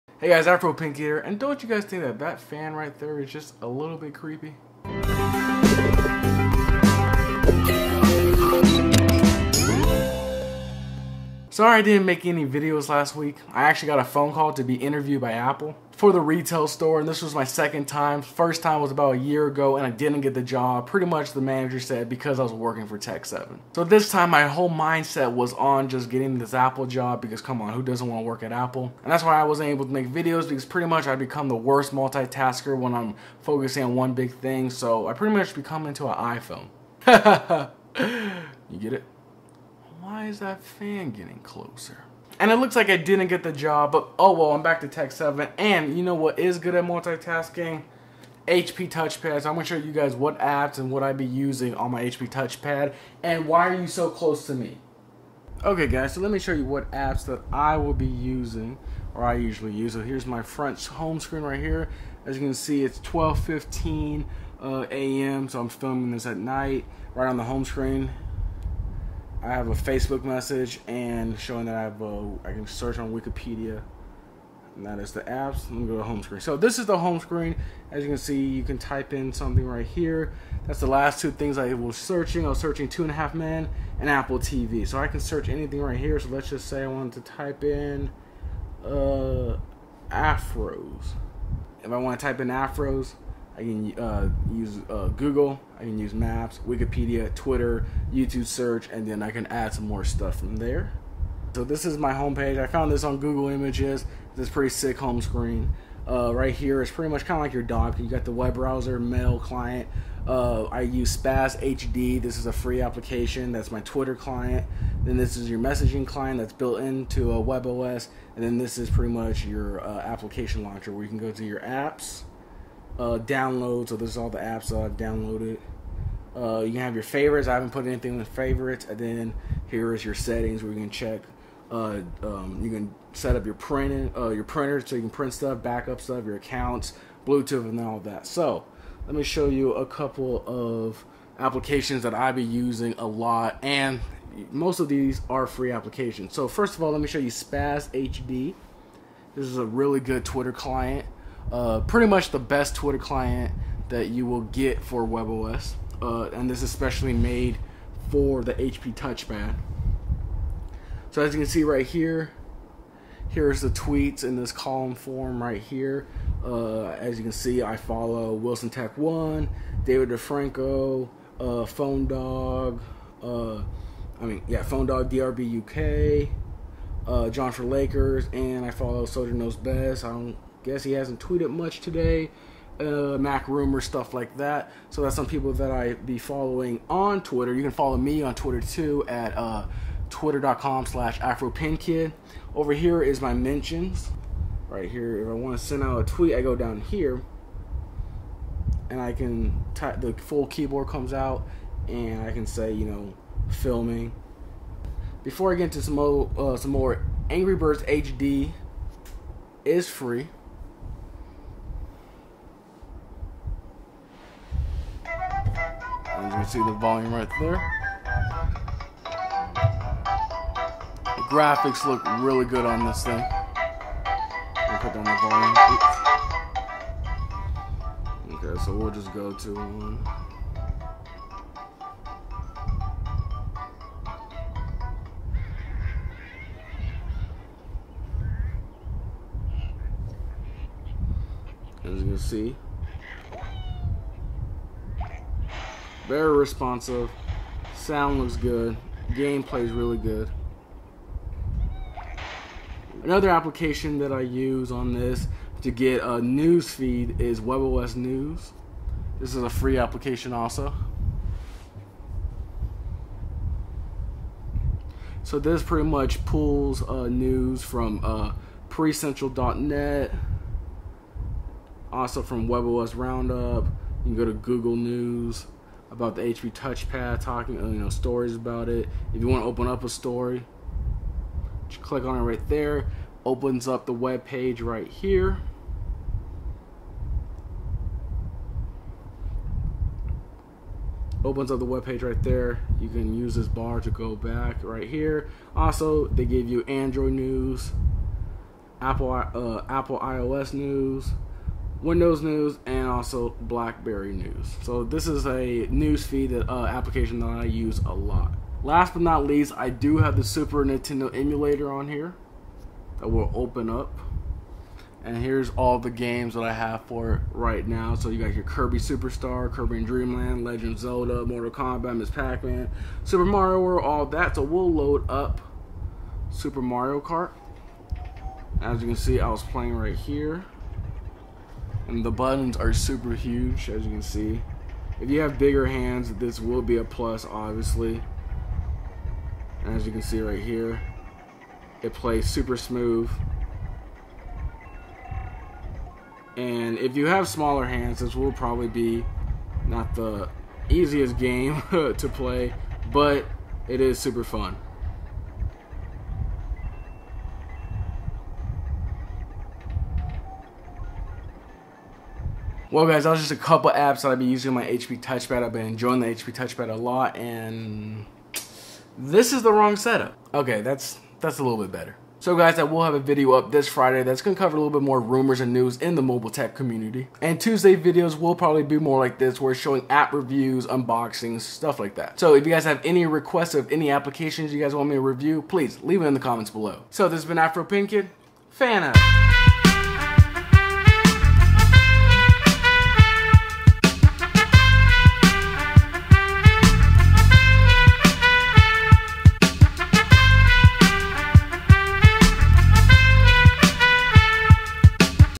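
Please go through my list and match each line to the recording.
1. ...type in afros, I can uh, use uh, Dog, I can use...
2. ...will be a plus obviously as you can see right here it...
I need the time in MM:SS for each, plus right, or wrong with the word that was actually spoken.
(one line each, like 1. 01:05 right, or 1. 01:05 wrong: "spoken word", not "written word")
1. 01:32 wrong: "Google", not "Dog"
2. 05:36 right.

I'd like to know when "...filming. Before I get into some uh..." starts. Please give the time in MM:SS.
03:23.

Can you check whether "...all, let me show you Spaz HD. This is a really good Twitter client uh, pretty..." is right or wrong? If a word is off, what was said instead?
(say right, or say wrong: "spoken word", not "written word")
right.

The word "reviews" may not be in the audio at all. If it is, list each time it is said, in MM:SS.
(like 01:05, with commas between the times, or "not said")
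06:20, 06:25.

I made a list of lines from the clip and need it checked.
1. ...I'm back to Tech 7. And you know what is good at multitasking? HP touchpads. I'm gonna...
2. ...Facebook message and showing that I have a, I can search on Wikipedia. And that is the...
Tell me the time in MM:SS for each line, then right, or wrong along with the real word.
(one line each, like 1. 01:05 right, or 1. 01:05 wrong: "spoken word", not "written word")
1. 00:44 right
2. 01:09 right.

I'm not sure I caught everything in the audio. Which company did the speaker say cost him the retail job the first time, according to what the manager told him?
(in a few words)
Tech7.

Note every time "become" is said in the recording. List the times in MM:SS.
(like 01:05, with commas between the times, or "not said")
00:31, 00:35.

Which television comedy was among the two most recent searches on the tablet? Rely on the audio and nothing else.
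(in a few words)
Two and a Half Men.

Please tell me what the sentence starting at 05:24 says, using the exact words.
So we'll load up Super Mario Kart.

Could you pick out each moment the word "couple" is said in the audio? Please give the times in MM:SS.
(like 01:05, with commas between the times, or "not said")
02:19, 06:03.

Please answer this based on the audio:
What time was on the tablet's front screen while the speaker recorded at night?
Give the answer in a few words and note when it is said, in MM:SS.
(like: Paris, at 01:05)
12:15 a.m., at 01:03.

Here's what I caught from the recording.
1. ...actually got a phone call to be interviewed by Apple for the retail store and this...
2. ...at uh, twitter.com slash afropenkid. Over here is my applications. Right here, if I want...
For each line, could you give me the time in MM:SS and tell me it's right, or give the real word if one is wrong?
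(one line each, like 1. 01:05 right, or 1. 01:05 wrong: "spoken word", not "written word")
1. 00:13 right
2. 03:09 wrong: "mentions", not "applications".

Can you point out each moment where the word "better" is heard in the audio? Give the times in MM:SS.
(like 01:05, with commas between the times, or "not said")
06:11.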